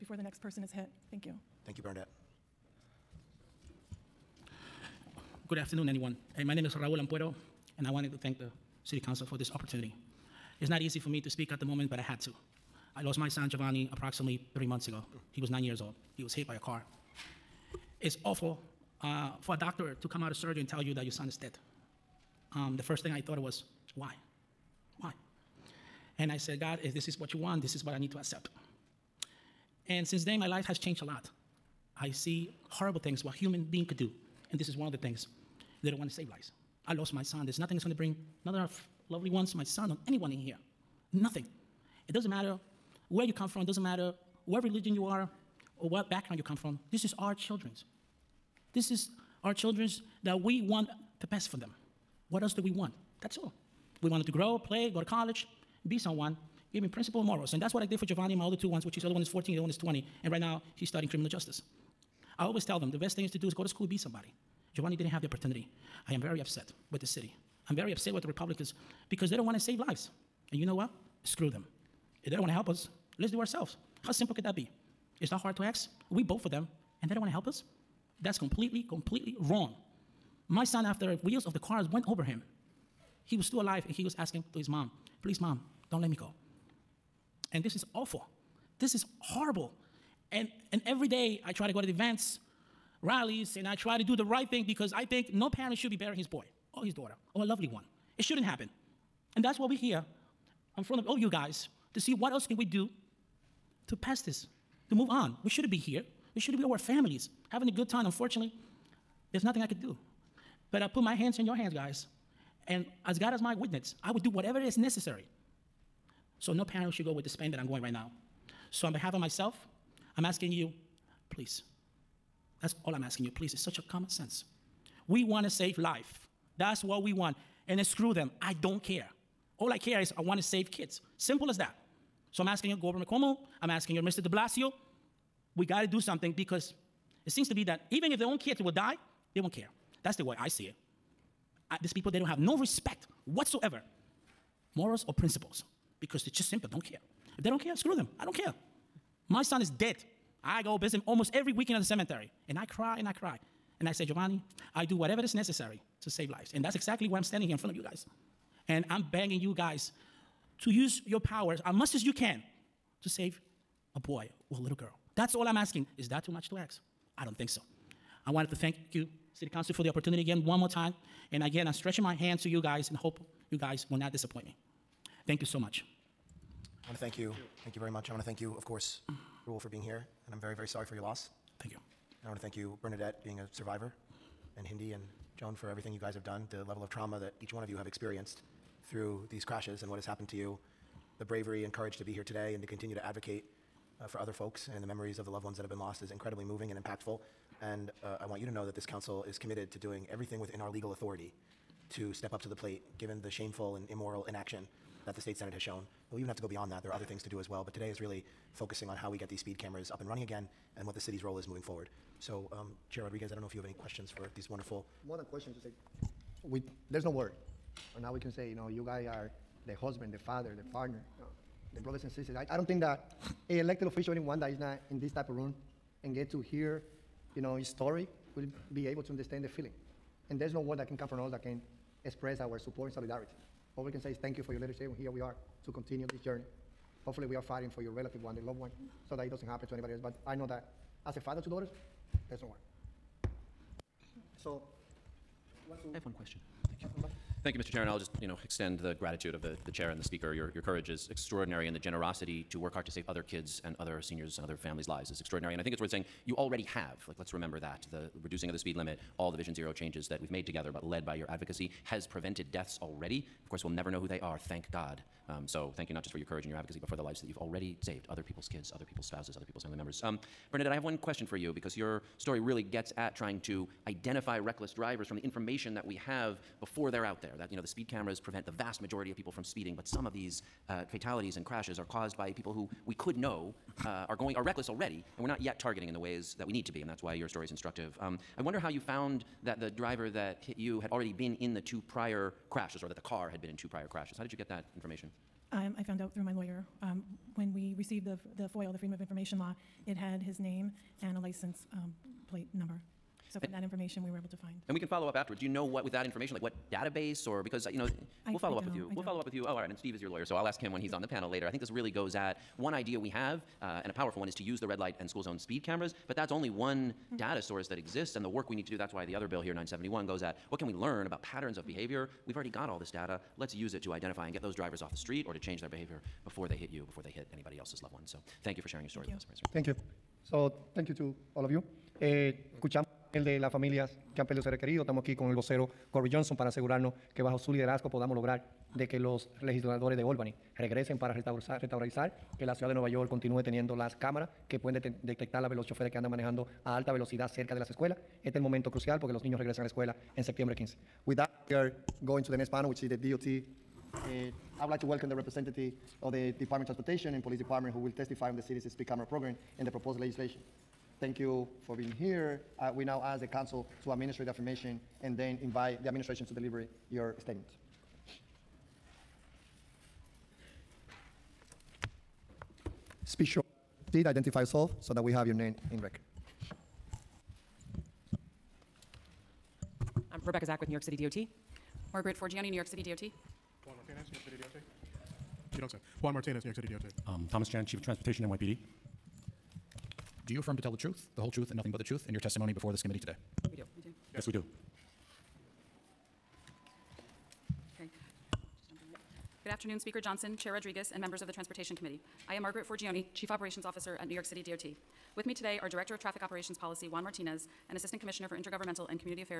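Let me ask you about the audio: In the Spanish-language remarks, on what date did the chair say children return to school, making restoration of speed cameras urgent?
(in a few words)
September 15.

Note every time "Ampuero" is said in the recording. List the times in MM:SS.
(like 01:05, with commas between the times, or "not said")
00:07.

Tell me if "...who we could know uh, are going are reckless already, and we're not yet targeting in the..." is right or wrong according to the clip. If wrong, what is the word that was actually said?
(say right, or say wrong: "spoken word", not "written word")
right.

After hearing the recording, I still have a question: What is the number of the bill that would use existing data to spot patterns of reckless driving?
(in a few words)
971.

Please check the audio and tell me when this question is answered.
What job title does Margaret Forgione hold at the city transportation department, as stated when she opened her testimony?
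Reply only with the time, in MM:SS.
06:43.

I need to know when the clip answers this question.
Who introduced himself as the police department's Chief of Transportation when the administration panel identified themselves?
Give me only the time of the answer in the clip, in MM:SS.
06:27.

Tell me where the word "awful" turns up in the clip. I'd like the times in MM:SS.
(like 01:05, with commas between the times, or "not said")
00:18, 01:27.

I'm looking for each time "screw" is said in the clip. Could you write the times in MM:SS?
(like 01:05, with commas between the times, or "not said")
01:11, 02:07, 02:27.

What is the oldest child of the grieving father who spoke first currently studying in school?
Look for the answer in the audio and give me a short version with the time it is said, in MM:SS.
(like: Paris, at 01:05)
Criminal justice, at 01:01.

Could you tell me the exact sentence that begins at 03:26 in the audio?
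We even have to go beyond that.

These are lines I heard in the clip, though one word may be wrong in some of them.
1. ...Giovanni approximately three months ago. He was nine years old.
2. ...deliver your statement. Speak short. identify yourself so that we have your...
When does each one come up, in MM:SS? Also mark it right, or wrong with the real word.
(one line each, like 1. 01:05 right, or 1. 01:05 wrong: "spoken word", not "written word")
1. 00:13 right
2. 06:06 right.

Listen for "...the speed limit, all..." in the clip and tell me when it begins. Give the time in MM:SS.
04:18.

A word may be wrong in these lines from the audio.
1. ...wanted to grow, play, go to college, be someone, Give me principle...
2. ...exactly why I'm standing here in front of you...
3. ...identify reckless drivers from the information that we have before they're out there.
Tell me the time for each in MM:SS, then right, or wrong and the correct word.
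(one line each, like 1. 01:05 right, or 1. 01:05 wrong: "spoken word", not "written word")
1. 00:54 right
2. 02:36 right
3. 04:33 right.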